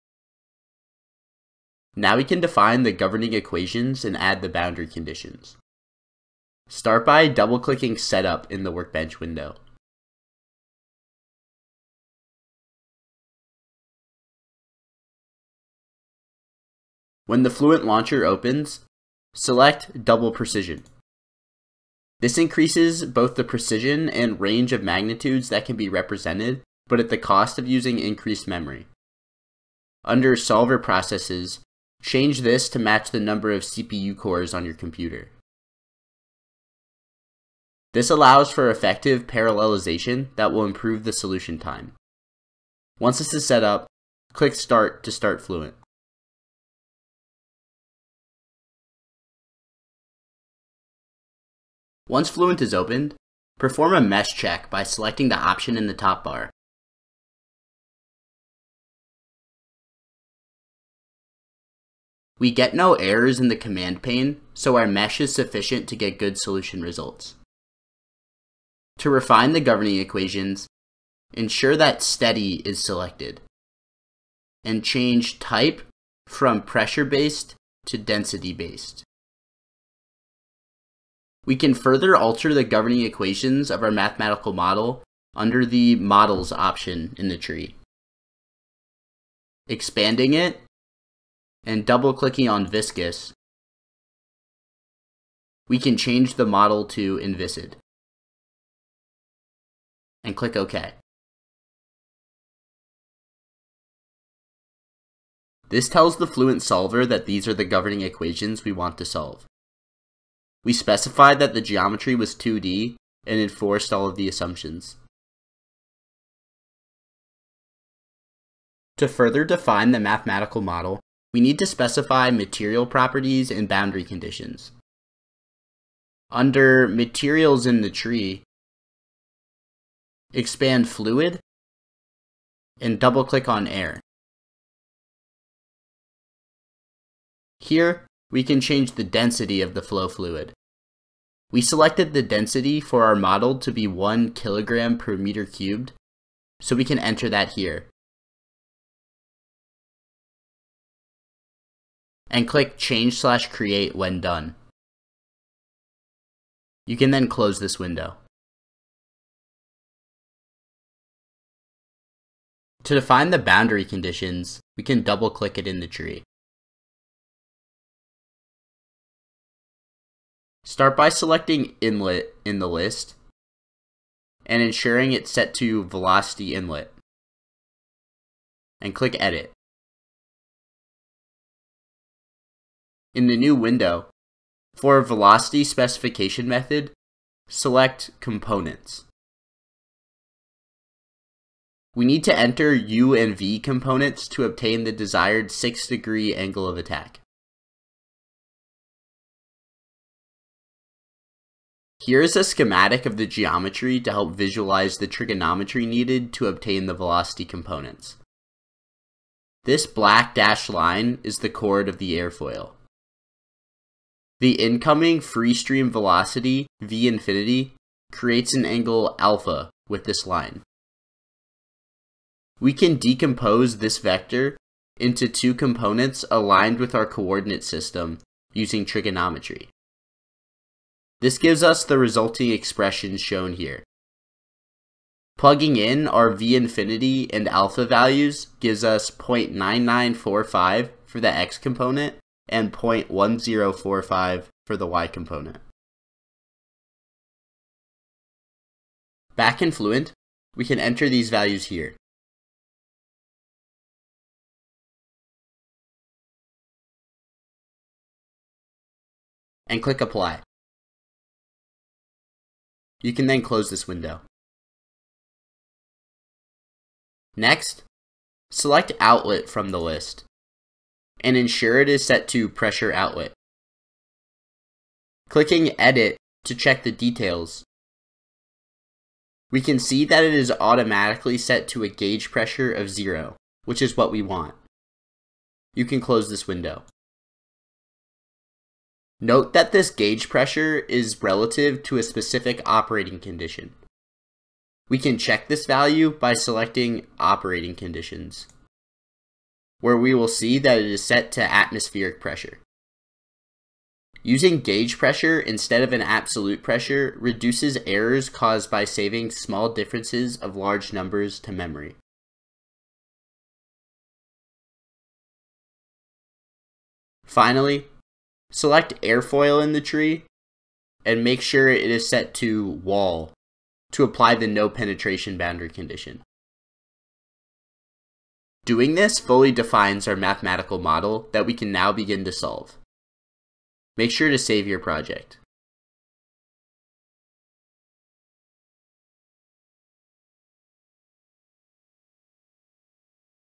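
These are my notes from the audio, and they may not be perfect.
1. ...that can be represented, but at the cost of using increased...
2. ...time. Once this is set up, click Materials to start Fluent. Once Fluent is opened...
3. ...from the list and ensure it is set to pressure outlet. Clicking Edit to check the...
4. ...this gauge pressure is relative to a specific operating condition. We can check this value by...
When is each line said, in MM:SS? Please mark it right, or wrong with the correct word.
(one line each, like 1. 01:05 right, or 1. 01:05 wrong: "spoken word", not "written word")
1. 00:25 right
2. 00:41 wrong: "Start", not "Materials"
3. 04:29 right
4. 04:49 right.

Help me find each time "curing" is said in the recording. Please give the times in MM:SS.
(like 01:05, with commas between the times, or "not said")
not said.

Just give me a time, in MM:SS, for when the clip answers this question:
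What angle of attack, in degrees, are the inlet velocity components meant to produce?
03:15.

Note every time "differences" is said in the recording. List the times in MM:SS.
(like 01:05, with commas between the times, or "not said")
05:09.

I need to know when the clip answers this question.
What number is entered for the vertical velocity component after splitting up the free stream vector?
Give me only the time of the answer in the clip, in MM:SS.
04:02.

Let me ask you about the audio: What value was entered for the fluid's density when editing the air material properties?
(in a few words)
1 kg/m³.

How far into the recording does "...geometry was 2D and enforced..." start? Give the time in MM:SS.
01:51.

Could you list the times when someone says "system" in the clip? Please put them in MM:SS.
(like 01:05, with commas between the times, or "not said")
03:47.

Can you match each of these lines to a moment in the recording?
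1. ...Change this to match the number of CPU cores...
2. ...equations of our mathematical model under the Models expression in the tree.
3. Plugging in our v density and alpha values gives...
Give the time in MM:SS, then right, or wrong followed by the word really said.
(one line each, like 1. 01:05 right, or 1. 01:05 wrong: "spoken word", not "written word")
1. 00:32 right
2. 01:23 wrong: "option", not "expression"
3. 03:55 wrong: "infinity", not "density".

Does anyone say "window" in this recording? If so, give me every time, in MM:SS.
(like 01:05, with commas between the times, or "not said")
00:09, 02:37, 03:03, 04:23, 04:46.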